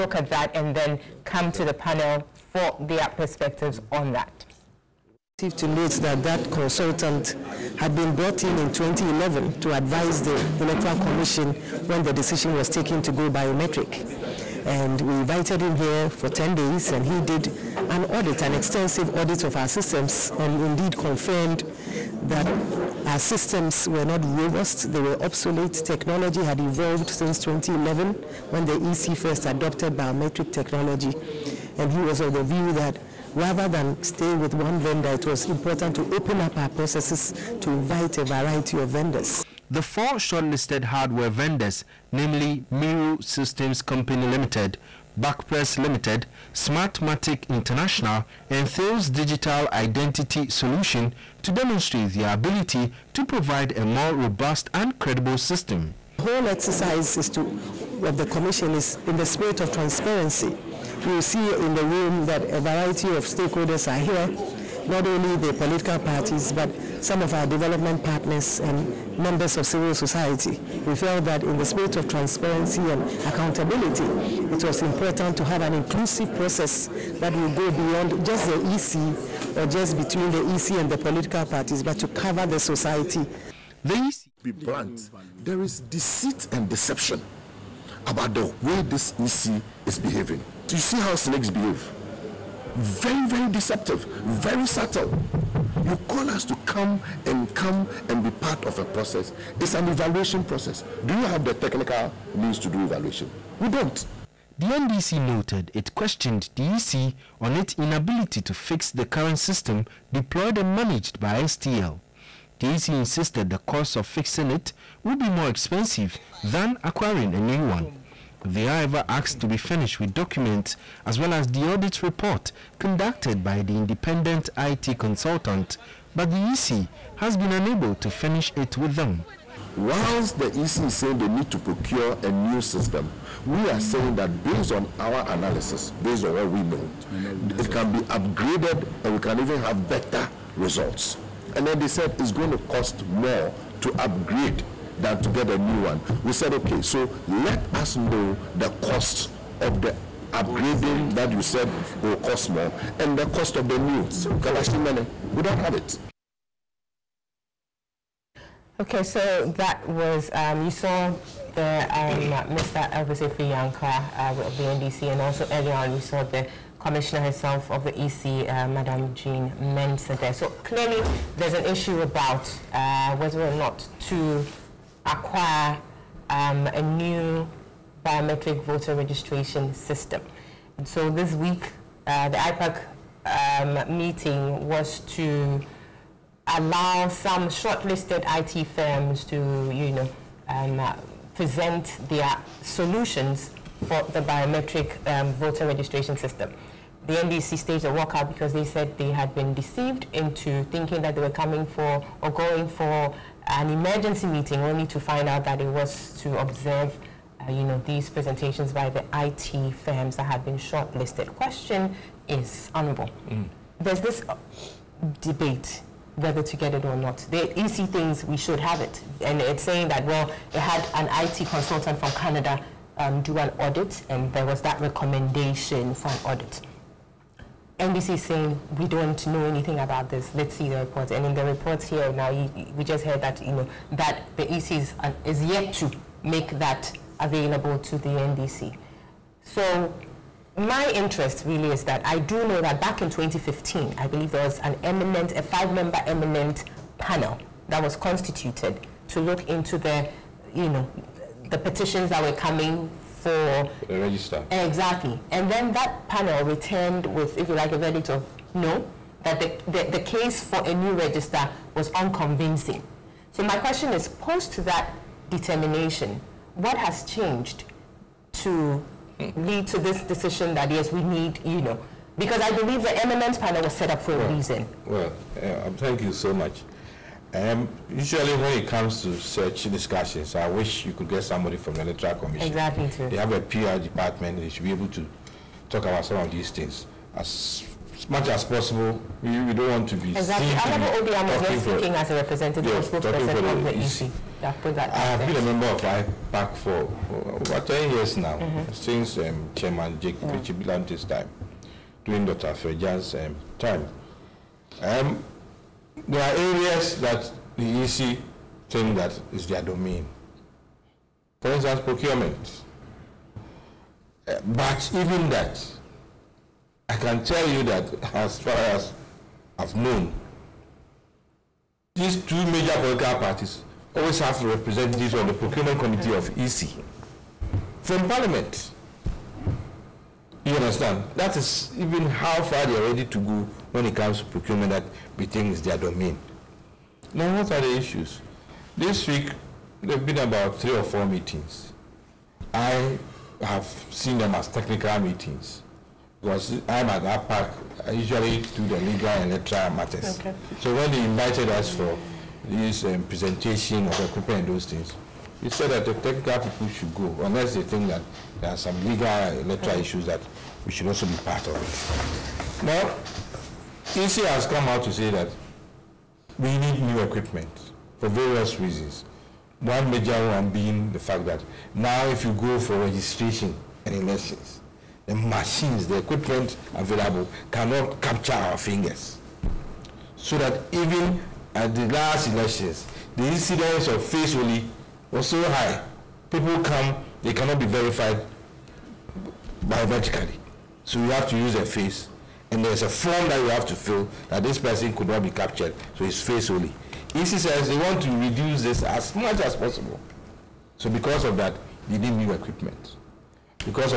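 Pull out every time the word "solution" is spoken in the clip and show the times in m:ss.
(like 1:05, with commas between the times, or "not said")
0:50, 3:12.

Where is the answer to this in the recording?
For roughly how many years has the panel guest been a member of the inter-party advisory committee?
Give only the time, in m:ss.
4:57.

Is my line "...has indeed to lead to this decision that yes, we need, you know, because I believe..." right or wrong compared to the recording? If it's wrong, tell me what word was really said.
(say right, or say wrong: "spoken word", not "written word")
wrong: "changed", not "indeed".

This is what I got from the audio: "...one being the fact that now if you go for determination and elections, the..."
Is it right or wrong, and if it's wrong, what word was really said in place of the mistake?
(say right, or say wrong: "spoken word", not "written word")
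wrong: "registration", not "determination".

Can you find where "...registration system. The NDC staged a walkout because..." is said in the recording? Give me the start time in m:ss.
3:15.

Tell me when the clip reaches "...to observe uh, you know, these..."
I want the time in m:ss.
3:26.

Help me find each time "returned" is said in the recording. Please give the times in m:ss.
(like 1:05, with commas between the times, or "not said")
4:16.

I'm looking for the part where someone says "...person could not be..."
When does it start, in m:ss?
6:34.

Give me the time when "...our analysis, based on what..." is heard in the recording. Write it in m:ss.
2:14.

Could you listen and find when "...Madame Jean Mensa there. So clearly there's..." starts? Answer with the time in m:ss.
2:48.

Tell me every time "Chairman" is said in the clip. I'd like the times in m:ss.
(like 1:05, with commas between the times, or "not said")
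4:59.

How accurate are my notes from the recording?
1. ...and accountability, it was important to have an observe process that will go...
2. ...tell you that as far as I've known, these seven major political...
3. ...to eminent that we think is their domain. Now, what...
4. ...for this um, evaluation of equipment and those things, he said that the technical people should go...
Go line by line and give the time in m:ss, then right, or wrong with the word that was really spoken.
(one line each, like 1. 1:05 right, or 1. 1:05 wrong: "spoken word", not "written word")
1. 1:12 wrong: "inclusive", not "observe"
2. 5:17 wrong: "two", not "seven"
3. 5:34 wrong: "procurement", not "eminent"
4. 5:51 wrong: "presentation", not "evaluation".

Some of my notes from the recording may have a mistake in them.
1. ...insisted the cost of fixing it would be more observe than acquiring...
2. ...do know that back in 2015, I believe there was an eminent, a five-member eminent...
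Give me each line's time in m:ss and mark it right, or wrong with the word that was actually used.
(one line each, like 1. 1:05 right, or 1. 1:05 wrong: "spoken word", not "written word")
1. 1:52 wrong: "expensive", not "observe"
2. 4:02 right.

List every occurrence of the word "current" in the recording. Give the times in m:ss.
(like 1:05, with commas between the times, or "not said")
1:49.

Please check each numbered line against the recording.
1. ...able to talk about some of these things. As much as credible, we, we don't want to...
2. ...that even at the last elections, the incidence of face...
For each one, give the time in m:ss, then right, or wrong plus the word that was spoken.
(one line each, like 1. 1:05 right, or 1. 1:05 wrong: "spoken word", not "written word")
1. 4:44 wrong: "possible", not "credible"
2. 6:20 right.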